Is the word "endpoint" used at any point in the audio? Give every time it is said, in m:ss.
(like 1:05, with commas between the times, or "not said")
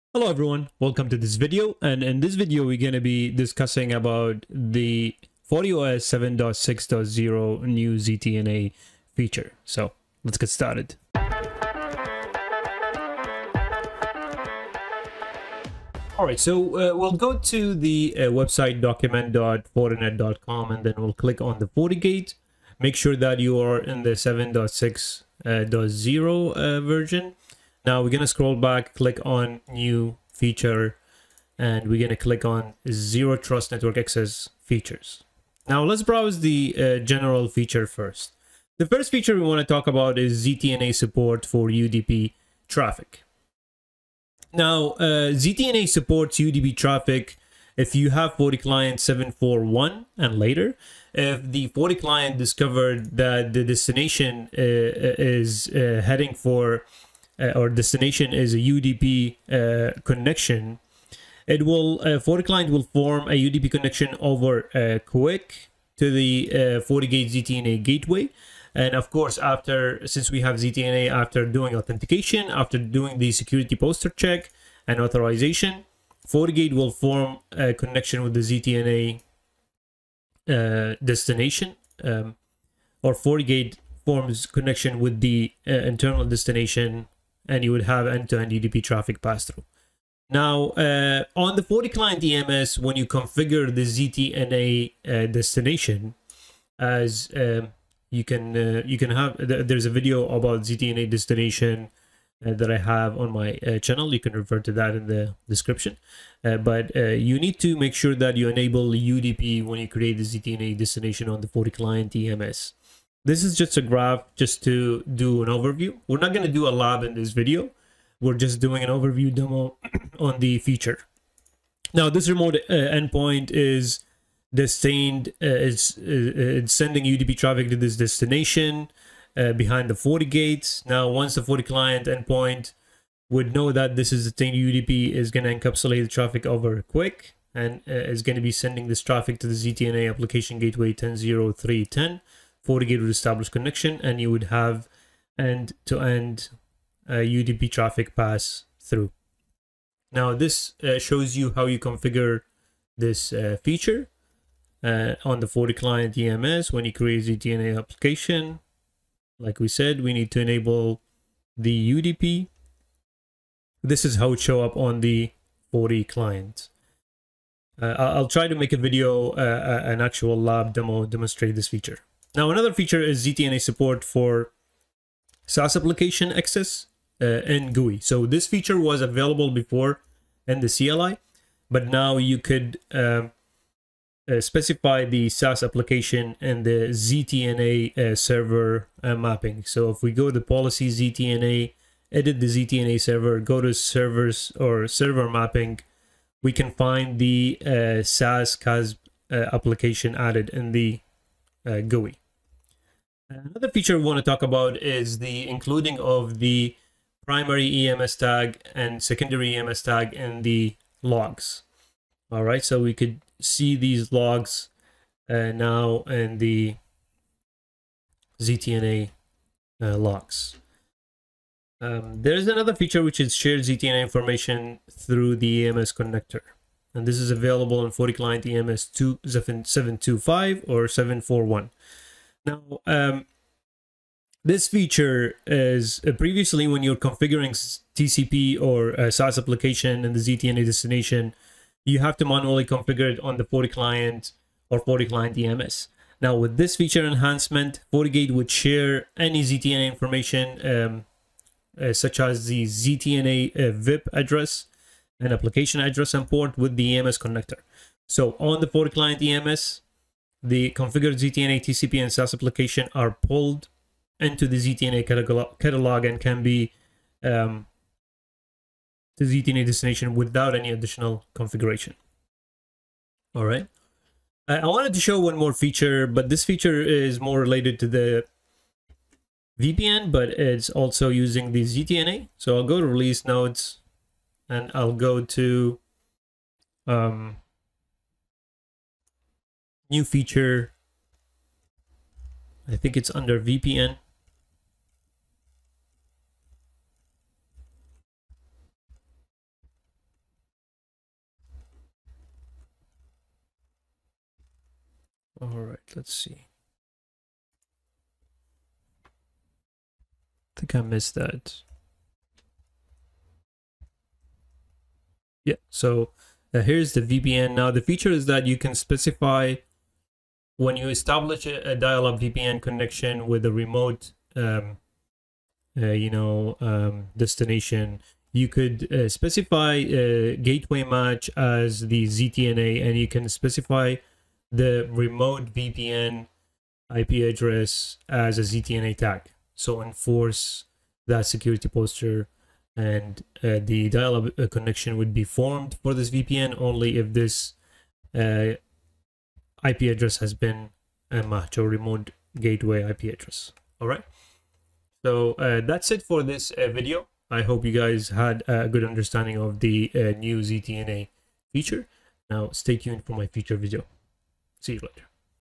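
2:02, 2:12.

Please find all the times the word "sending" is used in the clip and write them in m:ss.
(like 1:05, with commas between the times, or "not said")
2:06, 2:18.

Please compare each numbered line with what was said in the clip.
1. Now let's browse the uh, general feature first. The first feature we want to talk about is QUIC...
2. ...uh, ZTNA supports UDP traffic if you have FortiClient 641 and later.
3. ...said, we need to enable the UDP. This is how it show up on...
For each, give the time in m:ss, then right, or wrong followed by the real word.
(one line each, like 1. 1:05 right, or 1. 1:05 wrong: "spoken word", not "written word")
1. 0:35 wrong: "ZTNA", not "QUIC"
2. 0:44 wrong: "741", not "641"
3. 2:39 right.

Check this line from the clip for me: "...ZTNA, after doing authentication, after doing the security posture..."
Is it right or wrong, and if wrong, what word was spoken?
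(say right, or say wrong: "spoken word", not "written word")
right.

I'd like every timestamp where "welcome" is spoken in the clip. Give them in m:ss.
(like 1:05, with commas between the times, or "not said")
0:00.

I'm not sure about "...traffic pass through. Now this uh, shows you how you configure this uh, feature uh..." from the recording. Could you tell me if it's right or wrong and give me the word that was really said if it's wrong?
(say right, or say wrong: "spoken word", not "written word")
right.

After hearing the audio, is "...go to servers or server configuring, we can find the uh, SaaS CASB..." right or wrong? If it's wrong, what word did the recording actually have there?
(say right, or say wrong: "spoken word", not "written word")
wrong: "mapping", not "configuring".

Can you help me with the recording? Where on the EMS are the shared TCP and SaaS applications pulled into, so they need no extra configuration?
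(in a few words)
ZTNA catalog.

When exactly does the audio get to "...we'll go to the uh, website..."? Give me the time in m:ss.
0:16.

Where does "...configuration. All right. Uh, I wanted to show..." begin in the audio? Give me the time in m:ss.
4:31.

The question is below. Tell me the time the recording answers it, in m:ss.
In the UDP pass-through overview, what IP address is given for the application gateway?
2:20.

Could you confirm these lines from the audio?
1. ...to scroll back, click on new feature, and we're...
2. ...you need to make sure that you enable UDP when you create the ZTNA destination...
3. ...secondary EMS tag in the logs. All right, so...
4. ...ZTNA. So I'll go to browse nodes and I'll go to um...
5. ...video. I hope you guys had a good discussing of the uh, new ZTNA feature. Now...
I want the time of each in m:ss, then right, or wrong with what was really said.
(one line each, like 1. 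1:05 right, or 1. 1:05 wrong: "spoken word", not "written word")
1. 0:28 right
2. 1:47 right
3. 3:29 right
4. 4:41 wrong: "release", not "browse"
5. 5:56 wrong: "understanding", not "discussing".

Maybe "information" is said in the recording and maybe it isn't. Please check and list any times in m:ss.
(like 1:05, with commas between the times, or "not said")
3:44, 4:09.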